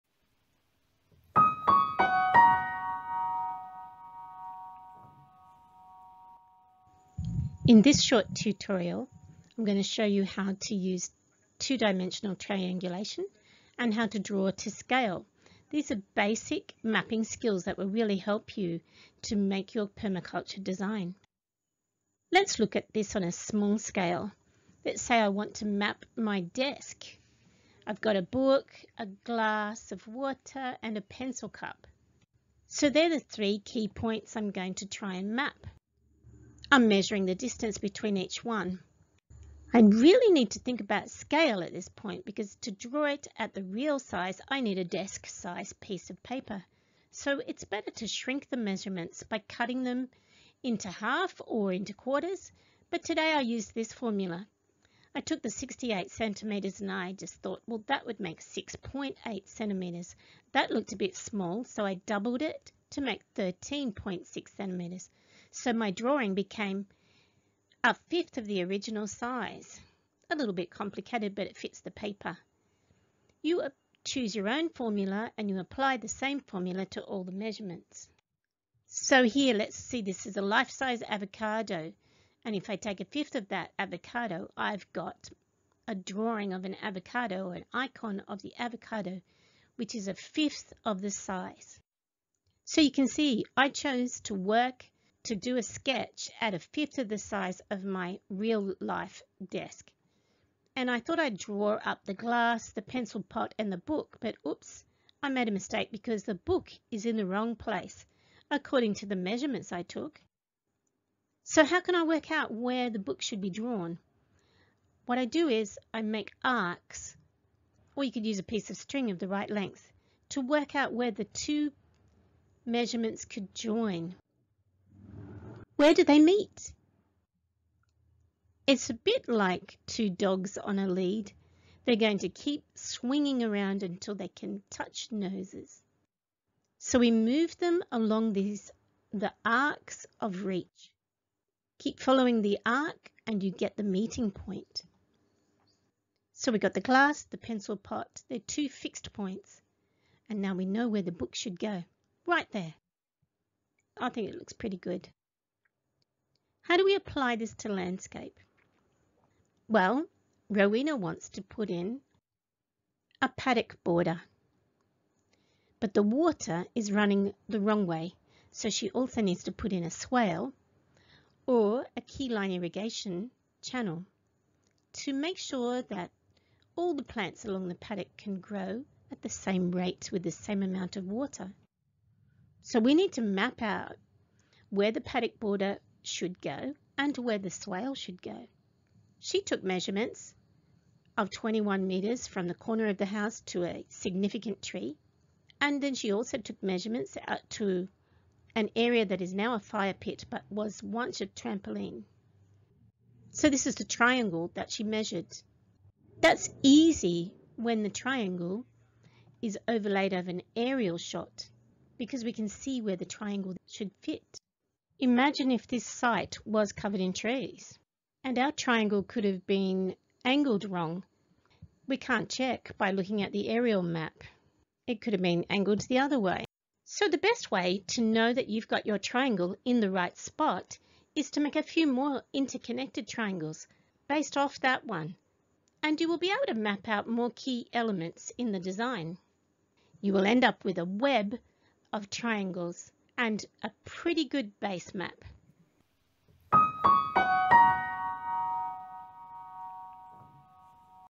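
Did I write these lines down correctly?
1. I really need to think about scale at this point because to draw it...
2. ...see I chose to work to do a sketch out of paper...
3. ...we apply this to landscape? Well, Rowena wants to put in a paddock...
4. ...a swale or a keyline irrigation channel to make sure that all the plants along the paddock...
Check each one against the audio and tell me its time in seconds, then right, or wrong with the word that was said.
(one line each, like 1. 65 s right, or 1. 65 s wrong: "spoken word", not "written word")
1. 39 s right
2. 93 s right
3. 156 s right
4. 169 s right.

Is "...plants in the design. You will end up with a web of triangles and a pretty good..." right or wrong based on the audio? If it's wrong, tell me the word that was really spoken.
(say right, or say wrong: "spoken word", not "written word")
wrong: "elements", not "plants".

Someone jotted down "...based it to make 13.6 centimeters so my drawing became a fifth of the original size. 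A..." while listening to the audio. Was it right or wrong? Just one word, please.
wrong.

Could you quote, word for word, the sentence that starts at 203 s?
So this is the triangle that she measured.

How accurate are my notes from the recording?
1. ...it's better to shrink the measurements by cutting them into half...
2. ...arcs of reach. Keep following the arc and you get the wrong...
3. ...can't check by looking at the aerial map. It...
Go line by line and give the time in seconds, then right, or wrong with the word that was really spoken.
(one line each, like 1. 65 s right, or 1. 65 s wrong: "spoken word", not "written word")
1. 47 s right
2. 139 s wrong: "meeting", not "wrong"
3. 221 s right.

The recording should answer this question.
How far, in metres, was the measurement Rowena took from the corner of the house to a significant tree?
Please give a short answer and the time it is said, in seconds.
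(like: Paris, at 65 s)
21 metres, at 191 s.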